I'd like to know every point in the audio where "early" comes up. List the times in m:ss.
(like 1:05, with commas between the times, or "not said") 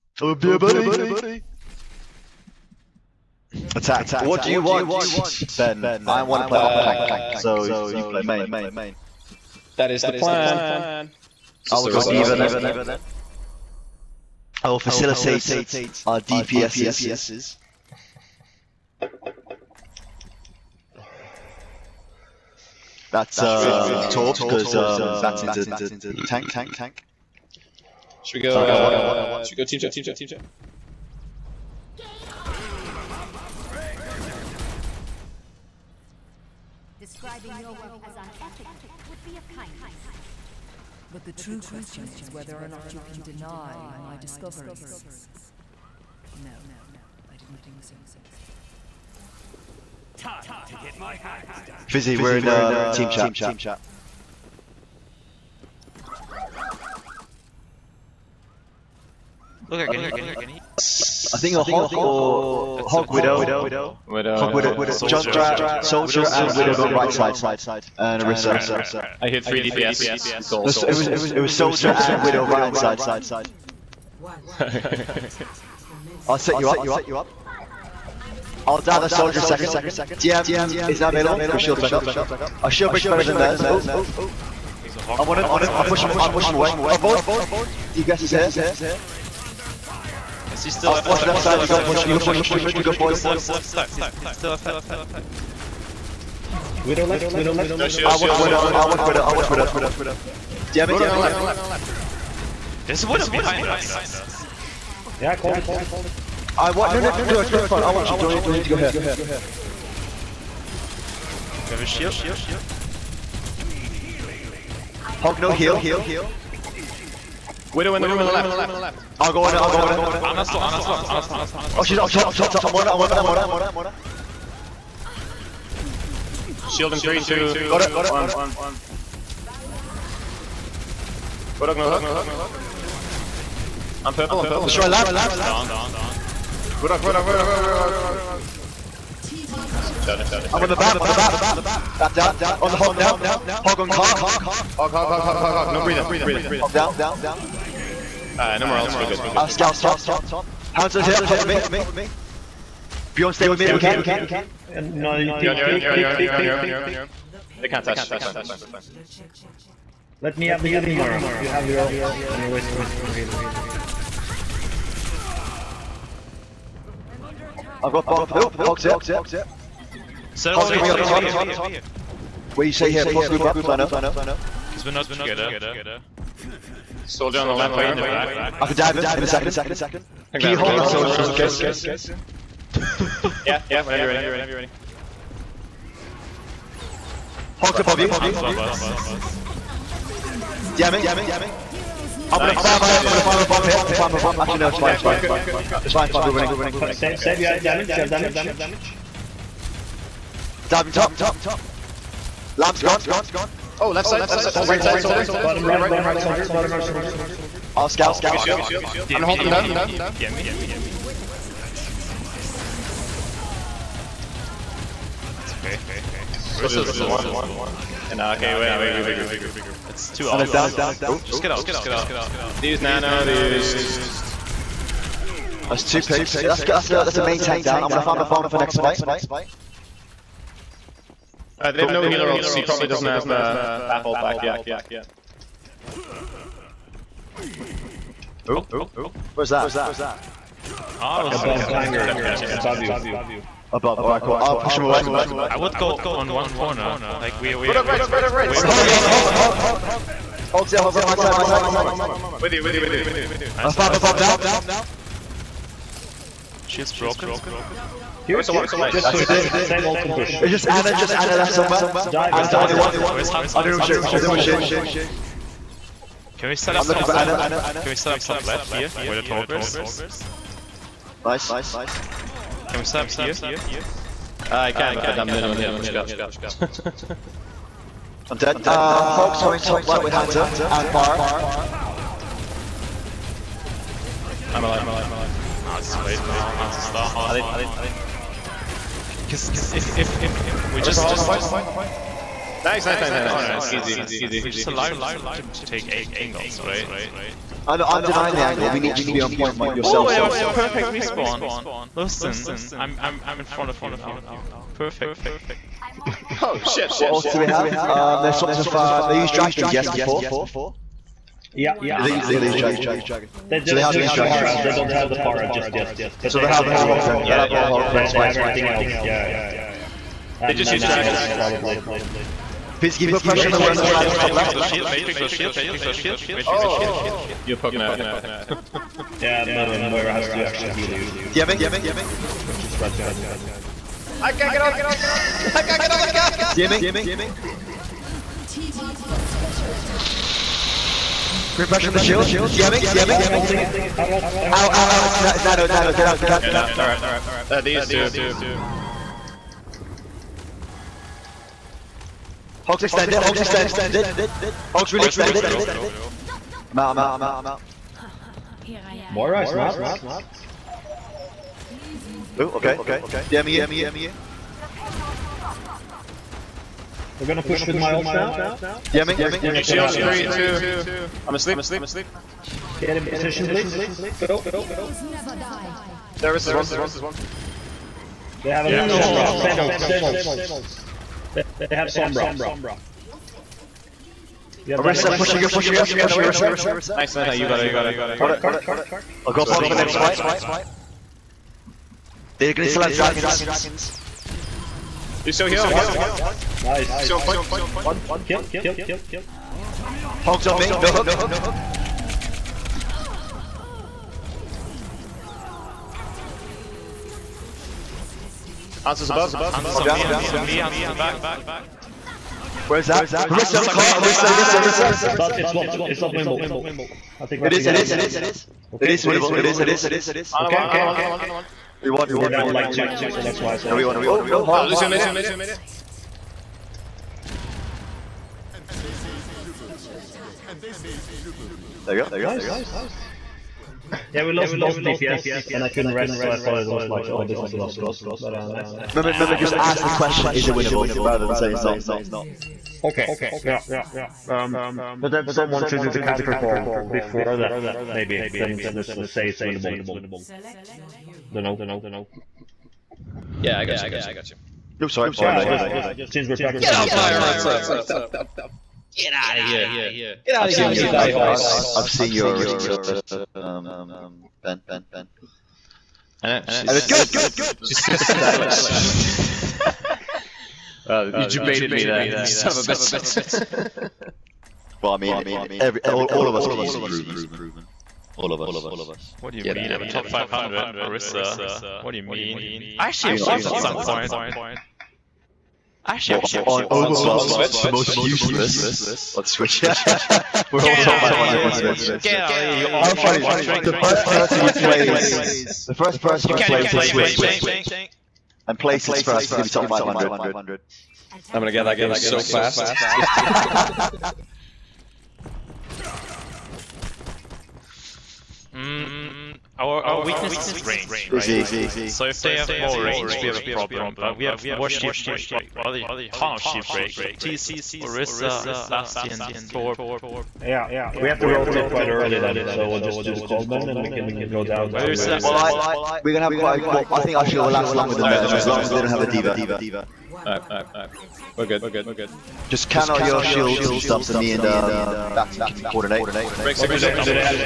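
8:41.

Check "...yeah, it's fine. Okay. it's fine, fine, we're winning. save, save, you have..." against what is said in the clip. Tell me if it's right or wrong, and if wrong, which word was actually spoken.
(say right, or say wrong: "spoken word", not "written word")
right.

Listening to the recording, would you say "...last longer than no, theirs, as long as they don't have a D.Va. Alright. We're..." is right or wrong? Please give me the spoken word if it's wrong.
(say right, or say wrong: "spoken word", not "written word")
right.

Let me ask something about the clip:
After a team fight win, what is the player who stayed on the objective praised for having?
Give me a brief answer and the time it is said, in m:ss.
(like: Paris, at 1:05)
A perfect respawn, at 5:00.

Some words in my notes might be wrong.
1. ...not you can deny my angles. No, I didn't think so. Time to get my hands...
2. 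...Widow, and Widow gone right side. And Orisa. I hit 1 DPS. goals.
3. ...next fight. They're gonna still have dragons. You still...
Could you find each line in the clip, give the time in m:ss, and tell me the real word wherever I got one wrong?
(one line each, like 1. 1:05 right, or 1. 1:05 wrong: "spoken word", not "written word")
1. 0:42 wrong: "discoveries", not "angles"
2. 1:06 wrong: "3", not "1"
3. 6:29 right.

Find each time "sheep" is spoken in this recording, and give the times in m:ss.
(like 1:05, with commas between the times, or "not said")
8:36.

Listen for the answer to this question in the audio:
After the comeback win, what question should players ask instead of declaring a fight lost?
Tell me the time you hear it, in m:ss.
7:20.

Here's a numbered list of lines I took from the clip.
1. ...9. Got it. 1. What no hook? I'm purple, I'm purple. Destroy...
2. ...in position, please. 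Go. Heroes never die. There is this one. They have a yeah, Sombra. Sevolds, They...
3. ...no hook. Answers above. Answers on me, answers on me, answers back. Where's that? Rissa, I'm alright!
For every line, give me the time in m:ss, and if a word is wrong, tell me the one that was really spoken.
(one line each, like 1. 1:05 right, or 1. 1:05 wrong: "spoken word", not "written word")
1. 2:07 wrong: "2", not "9"
2. 6:12 right
3. 6:40 wrong: "caught", not "alright".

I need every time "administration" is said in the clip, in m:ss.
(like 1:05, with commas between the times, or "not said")
not said.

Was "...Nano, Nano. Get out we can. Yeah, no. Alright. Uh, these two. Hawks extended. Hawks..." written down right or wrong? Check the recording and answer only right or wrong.
right.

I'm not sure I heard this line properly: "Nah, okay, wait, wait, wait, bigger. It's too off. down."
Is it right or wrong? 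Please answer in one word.
right.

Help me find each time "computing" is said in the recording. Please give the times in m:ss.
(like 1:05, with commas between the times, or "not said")
not said.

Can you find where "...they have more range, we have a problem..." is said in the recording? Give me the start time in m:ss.
8:32.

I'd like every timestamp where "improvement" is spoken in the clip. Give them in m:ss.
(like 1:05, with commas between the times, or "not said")
7:56.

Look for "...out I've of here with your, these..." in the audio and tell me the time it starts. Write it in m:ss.
7:40.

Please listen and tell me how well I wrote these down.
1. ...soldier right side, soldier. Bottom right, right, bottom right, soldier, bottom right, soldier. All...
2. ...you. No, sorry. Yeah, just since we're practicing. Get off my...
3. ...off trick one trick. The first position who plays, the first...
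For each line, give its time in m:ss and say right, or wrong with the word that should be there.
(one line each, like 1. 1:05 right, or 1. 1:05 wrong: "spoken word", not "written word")
1. 3:24 right
2. 7:33 right
3. 8:12 wrong: "person", not "position".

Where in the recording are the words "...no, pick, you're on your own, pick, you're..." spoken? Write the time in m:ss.
2:34.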